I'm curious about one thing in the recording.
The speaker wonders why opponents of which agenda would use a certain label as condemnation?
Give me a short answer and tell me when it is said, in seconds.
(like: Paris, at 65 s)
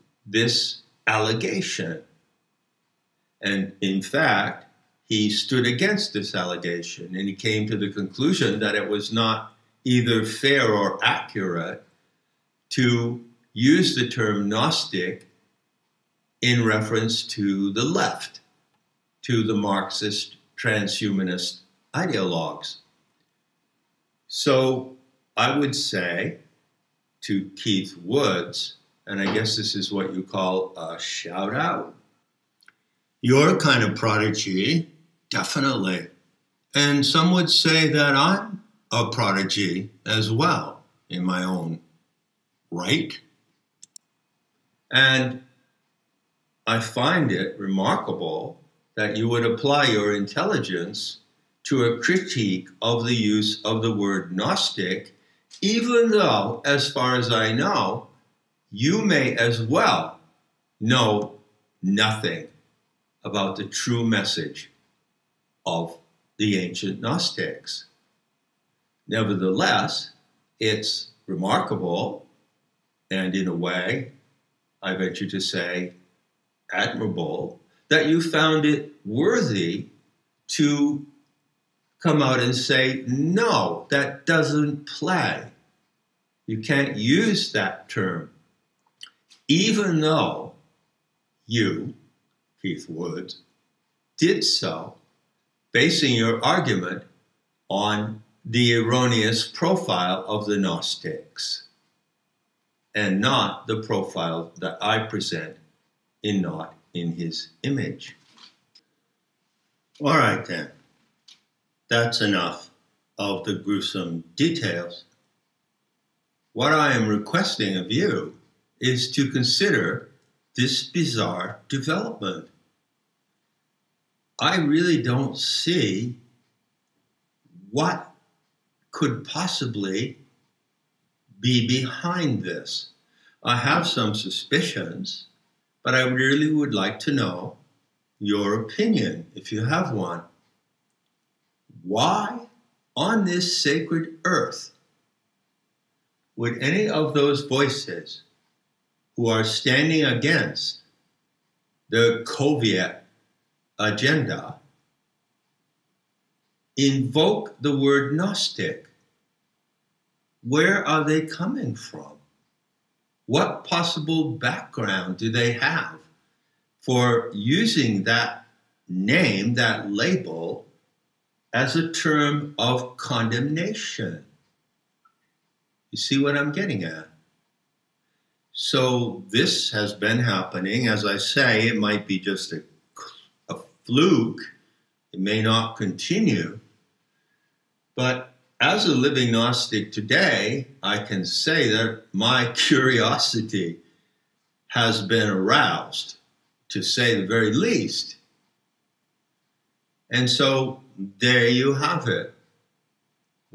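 the Soviet agenda, at 152 s.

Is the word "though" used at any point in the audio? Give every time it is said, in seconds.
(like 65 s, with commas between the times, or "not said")
56 s, 90 s.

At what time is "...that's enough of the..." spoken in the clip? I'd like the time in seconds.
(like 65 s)
111 s.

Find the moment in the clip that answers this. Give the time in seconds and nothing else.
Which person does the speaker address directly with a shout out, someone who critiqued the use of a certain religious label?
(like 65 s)
27 s.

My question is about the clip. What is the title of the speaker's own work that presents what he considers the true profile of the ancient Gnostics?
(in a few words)
Not in His Image.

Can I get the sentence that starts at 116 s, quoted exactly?
What I am requesting of you is to consider this bizarre development.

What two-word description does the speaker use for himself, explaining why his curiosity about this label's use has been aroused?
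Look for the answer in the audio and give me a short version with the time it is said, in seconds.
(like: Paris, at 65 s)
a living Gnostic, at 188 s.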